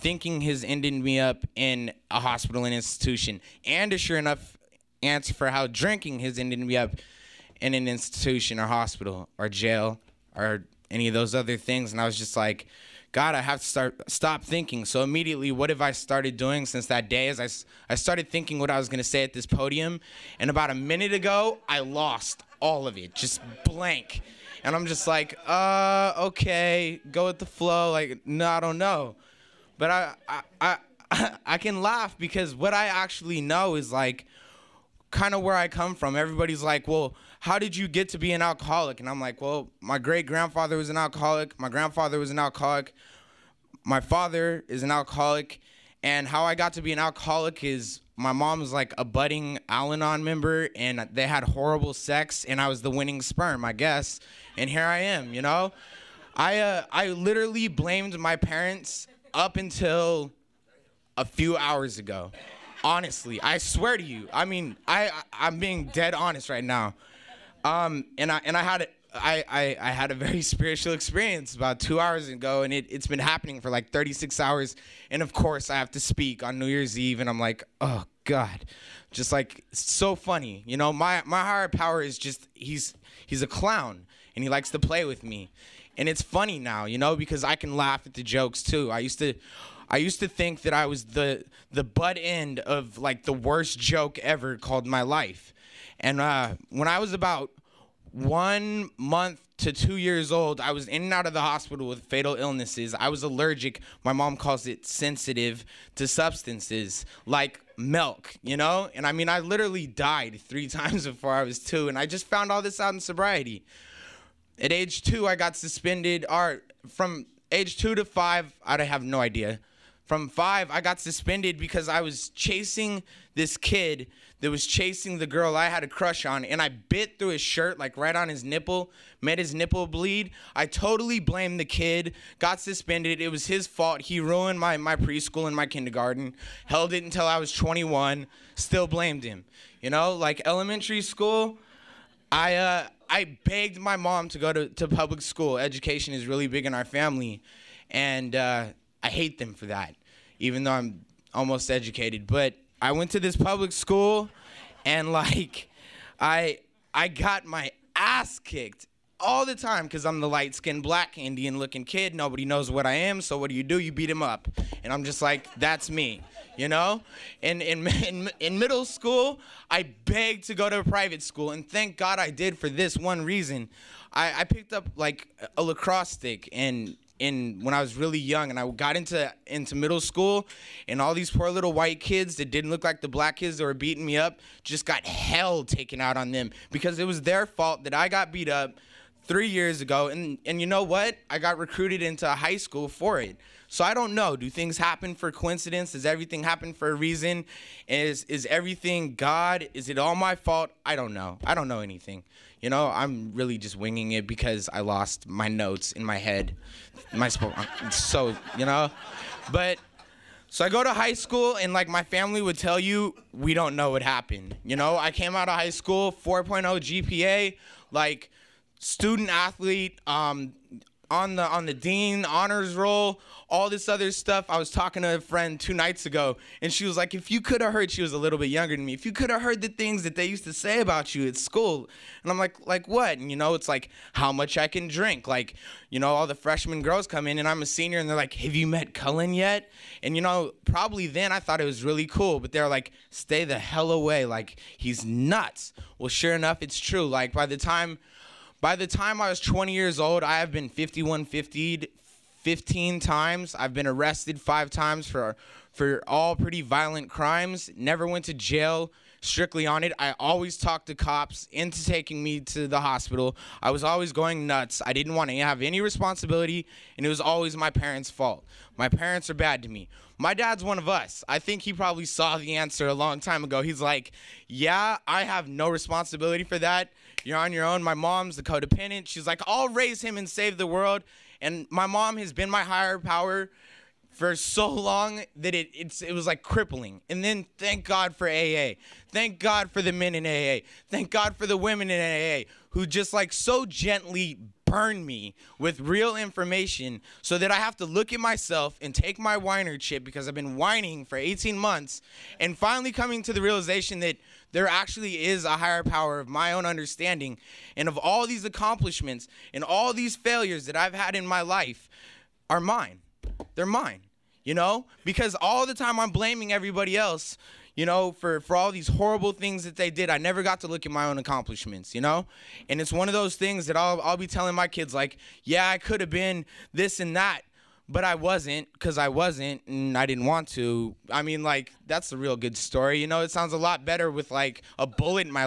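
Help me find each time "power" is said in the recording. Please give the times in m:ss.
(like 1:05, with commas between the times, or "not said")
1:21, 4:42, 5:05.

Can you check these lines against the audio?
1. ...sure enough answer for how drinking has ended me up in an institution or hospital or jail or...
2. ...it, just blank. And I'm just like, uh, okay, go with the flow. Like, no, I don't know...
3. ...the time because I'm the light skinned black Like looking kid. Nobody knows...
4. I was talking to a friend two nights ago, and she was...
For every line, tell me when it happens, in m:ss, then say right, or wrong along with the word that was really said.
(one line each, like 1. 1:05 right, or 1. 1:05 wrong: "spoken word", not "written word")
1. 0:03 right
2. 0:22 right
3. 2:39 wrong: "Indian", not "Like"
4. 3:44 right.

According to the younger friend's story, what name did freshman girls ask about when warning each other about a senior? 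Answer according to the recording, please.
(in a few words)
Cullen.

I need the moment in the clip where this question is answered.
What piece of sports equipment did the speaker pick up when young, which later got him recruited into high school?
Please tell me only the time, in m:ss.
2:55.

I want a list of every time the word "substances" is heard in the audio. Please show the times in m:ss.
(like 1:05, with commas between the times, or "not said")
1:46.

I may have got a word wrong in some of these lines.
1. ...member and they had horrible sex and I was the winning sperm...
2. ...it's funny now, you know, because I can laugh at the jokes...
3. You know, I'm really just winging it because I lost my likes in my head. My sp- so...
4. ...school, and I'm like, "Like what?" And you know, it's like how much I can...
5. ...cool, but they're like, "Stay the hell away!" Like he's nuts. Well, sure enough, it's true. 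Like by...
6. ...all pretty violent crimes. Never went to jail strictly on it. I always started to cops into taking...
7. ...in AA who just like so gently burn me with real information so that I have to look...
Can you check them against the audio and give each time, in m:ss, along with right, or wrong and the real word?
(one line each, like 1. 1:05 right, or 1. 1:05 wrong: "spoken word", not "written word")
1. 0:50 right
2. 1:26 right
3. 3:22 wrong: "notes", not "likes"
4. 3:51 right
5. 4:02 right
6. 4:16 wrong: "talked", not "started"
7. 4:51 right.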